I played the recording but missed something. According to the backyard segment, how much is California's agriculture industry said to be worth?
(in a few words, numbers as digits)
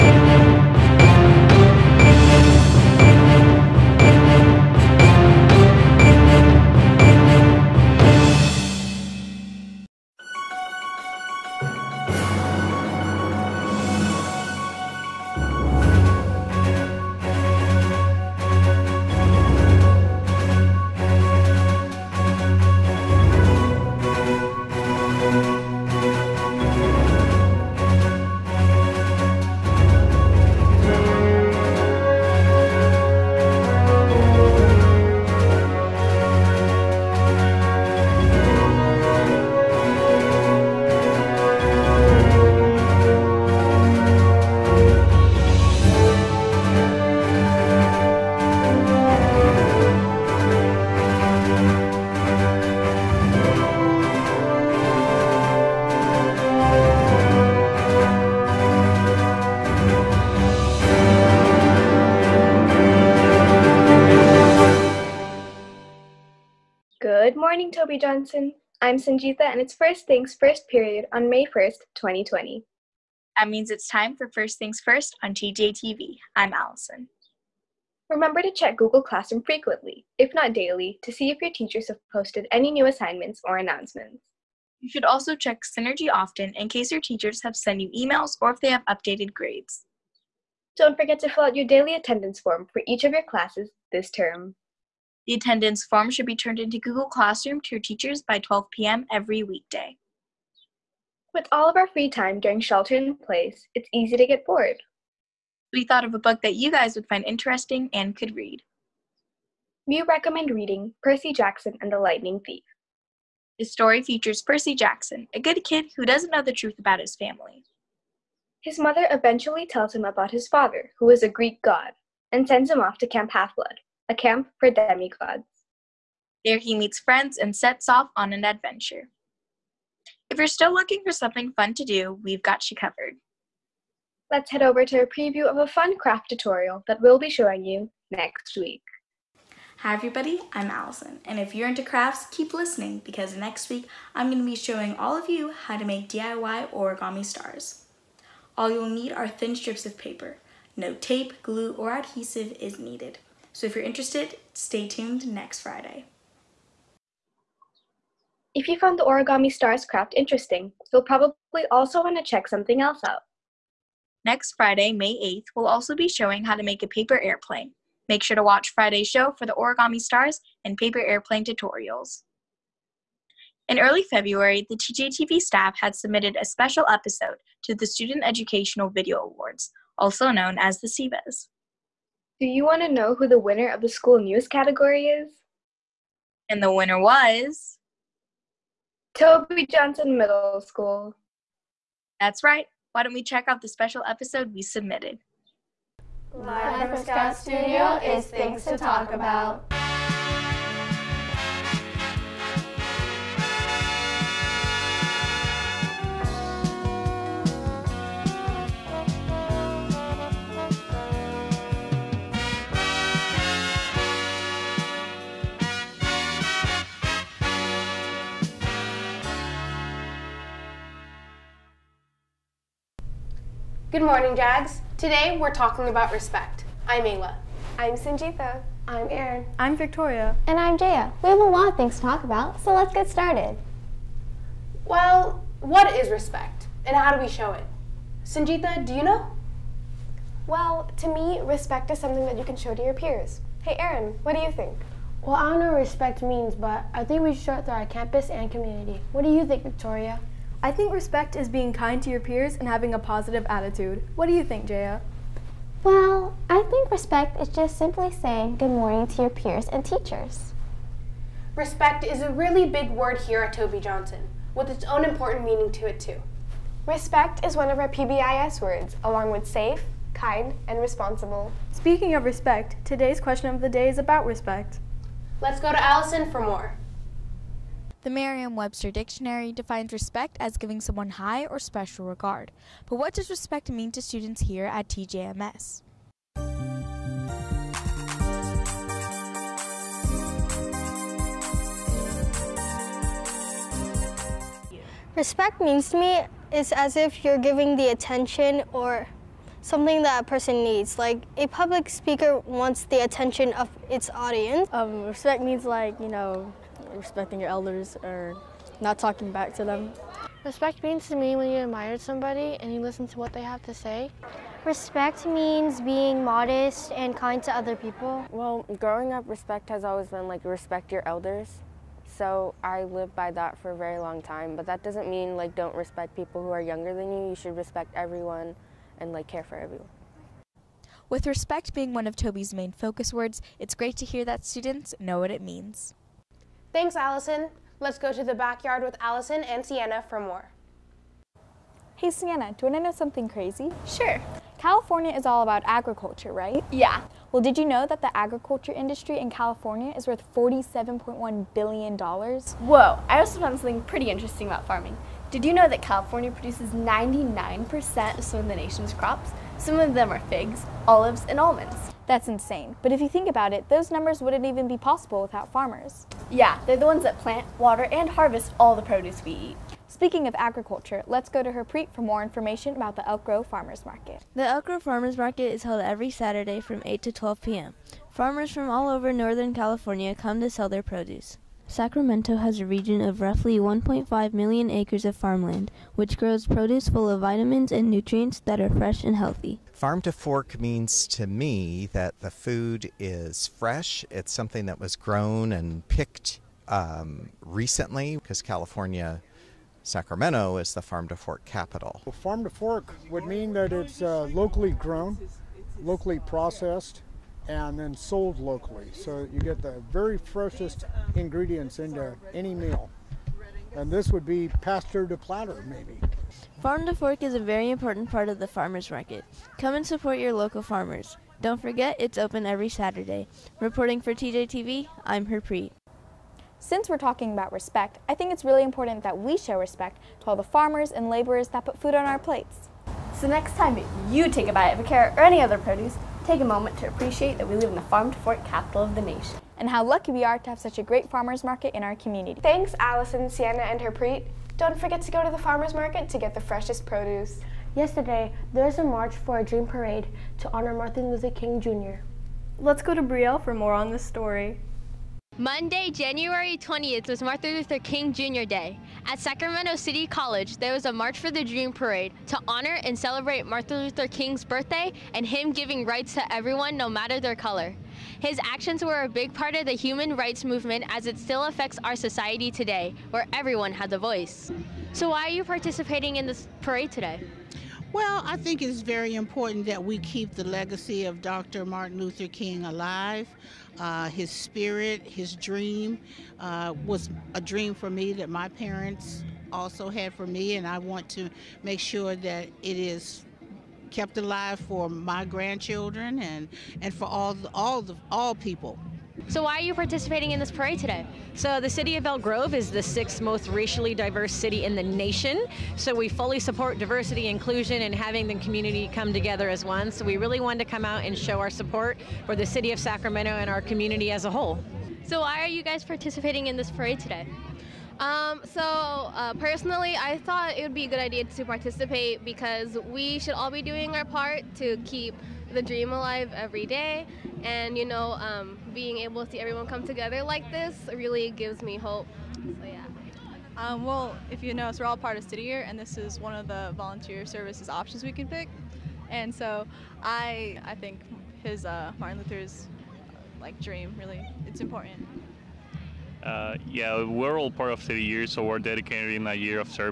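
$47.1 billion.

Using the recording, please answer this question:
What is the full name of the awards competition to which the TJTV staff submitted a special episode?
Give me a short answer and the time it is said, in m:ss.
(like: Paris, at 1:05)
Student Educational Video Awards, at 2:57.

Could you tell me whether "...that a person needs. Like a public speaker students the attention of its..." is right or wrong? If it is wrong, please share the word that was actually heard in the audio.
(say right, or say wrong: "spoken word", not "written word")
wrong: "wants", not "students".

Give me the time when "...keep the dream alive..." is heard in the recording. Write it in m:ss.
8:44.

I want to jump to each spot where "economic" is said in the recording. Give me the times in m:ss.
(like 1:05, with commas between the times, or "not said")
not said.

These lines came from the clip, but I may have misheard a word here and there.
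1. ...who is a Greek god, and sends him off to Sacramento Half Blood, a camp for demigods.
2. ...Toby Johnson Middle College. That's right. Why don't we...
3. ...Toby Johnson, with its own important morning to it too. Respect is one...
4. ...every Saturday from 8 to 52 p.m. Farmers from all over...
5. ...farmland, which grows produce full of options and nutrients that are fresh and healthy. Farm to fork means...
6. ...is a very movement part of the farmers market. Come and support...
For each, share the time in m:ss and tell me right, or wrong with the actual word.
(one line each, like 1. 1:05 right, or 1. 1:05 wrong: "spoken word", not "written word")
1. 2:00 wrong: "Camp", not "Sacramento"
2. 3:09 wrong: "School", not "College"
3. 4:23 wrong: "meaning", not "morning"
4. 6:15 wrong: "12", not "52"
5. 6:25 wrong: "vitamins", not "options"
6. 6:57 wrong: "important", not "movement".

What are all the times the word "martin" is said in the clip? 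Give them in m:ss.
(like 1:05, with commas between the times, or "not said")
7:30, 7:37, 7:43, 8:01, 9:01.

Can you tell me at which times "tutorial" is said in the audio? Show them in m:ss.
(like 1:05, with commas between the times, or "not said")
2:16, 2:51.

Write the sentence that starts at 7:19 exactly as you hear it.
And how lucky we are to have such a great farmers market in our community.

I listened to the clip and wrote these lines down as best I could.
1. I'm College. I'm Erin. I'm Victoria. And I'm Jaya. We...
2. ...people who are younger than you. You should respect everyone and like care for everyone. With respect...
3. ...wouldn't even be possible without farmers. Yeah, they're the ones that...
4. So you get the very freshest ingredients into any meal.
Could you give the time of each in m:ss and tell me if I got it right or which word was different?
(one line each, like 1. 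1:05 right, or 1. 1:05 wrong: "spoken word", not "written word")
1. 3:47 wrong: "Sanjita", not "College"
2. 5:26 right
3. 6:04 right
4. 6:48 right.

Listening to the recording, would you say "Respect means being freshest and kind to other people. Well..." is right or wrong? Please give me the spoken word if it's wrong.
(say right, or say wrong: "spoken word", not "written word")
wrong: "modest", not "freshest".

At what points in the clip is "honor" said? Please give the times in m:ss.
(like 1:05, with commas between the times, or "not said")
7:30, 7:42.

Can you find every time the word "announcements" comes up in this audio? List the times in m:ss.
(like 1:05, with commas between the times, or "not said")
1:23.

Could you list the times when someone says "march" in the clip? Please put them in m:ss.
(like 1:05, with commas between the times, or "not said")
7:28, 7:40.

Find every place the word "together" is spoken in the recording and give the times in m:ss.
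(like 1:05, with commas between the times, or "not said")
8:29, 8:49.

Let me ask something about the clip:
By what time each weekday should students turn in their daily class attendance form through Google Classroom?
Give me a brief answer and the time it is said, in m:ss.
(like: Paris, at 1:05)
12 p.m., at 1:38.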